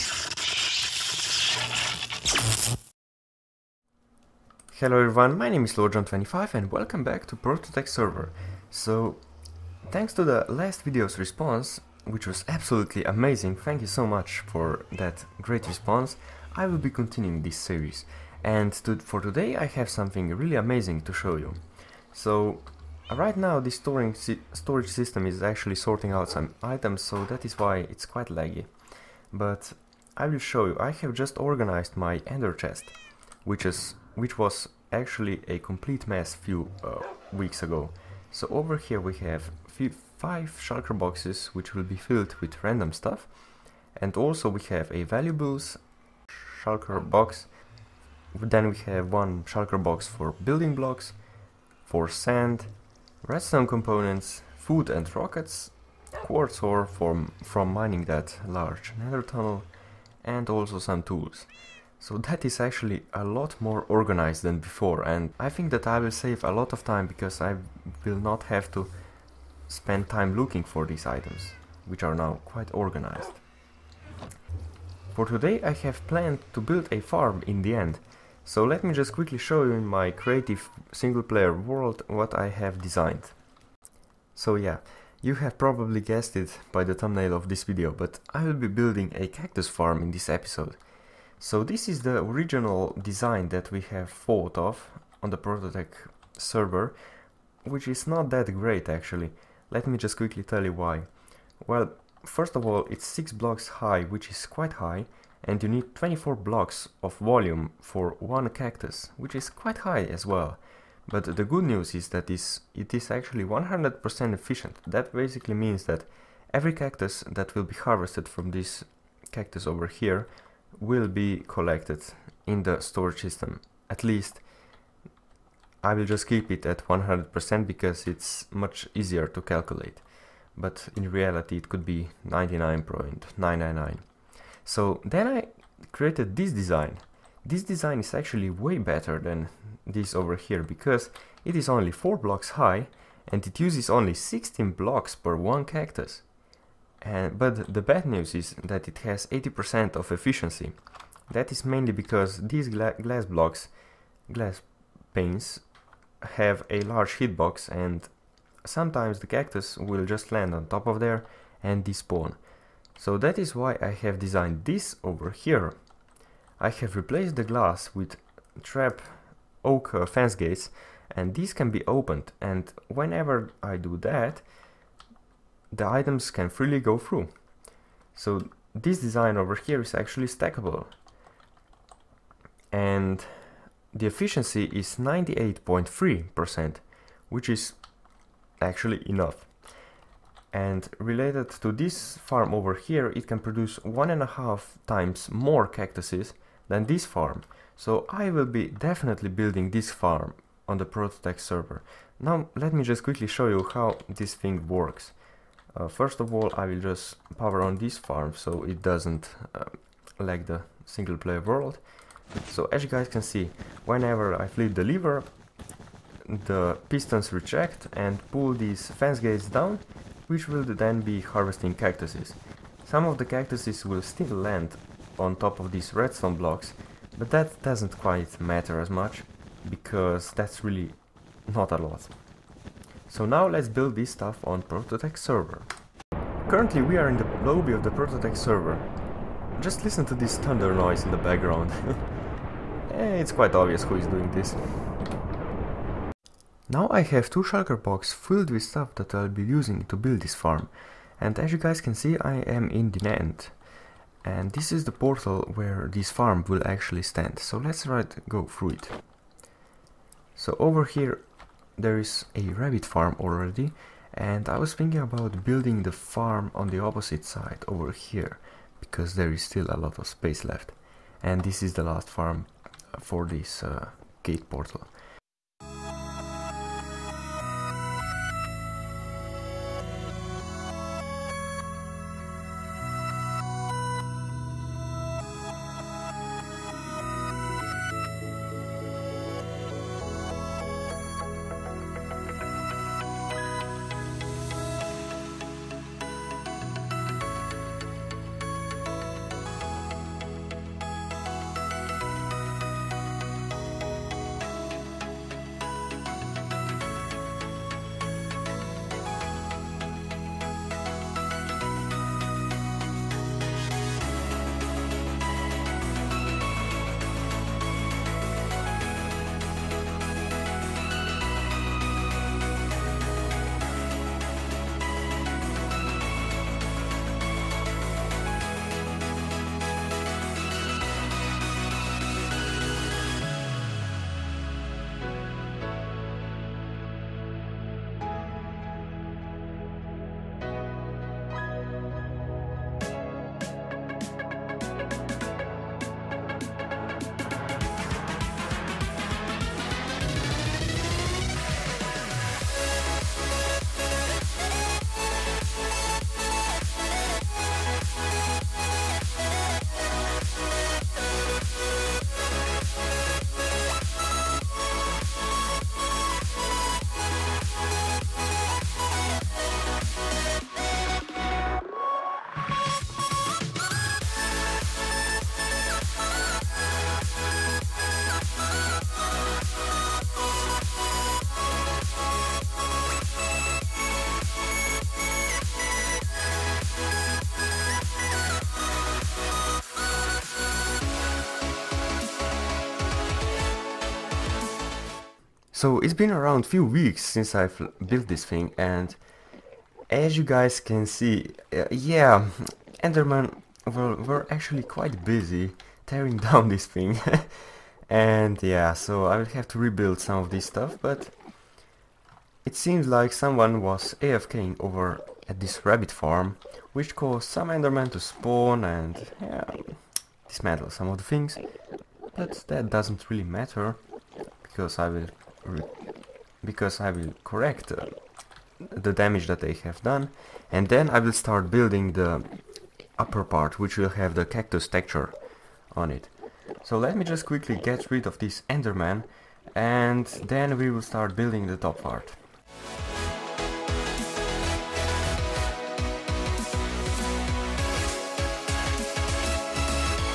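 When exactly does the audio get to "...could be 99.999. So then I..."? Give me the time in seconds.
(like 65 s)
131 s.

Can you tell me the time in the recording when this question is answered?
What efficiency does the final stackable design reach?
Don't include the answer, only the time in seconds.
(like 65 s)
184 s.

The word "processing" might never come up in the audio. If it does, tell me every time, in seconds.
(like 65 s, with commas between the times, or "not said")
not said.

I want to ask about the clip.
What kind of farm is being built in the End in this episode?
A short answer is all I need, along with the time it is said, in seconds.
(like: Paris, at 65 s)
Cactus farm, at 89 s.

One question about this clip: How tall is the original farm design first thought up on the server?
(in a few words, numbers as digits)
6 blocks.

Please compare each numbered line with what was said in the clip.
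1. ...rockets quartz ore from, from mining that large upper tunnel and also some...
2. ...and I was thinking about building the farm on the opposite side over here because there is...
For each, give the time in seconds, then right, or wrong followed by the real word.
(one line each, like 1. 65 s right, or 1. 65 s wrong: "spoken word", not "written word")
1. 55 s wrong: "nether", not "upper"
2. 264 s right.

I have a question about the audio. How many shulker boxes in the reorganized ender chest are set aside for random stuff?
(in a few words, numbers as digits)
5.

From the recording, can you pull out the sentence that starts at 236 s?
Currently we are in the lobby of the Prototech server.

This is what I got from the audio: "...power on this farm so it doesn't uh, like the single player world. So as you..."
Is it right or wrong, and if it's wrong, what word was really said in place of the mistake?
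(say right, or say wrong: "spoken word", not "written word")
right.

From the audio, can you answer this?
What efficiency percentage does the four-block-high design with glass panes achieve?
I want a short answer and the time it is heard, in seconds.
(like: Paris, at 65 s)
80%, at 149 s.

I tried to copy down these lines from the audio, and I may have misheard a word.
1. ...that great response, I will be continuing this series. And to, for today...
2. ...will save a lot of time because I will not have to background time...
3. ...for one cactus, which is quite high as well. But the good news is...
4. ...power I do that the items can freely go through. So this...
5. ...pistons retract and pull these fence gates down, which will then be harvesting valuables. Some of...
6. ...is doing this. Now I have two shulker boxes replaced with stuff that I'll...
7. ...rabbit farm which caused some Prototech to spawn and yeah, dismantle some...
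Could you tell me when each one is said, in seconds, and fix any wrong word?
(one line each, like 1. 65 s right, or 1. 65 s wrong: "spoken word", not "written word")
1. 14 s right
2. 65 s wrong: "spend", not "background"
3. 107 s right
4. 172 s wrong: "whenever", not "power"
5. 216 s wrong: "cactuses", not "valuables"
6. 243 s wrong: "filled", not "replaced"
7. 415 s wrong: "Enderman", not "Prototech".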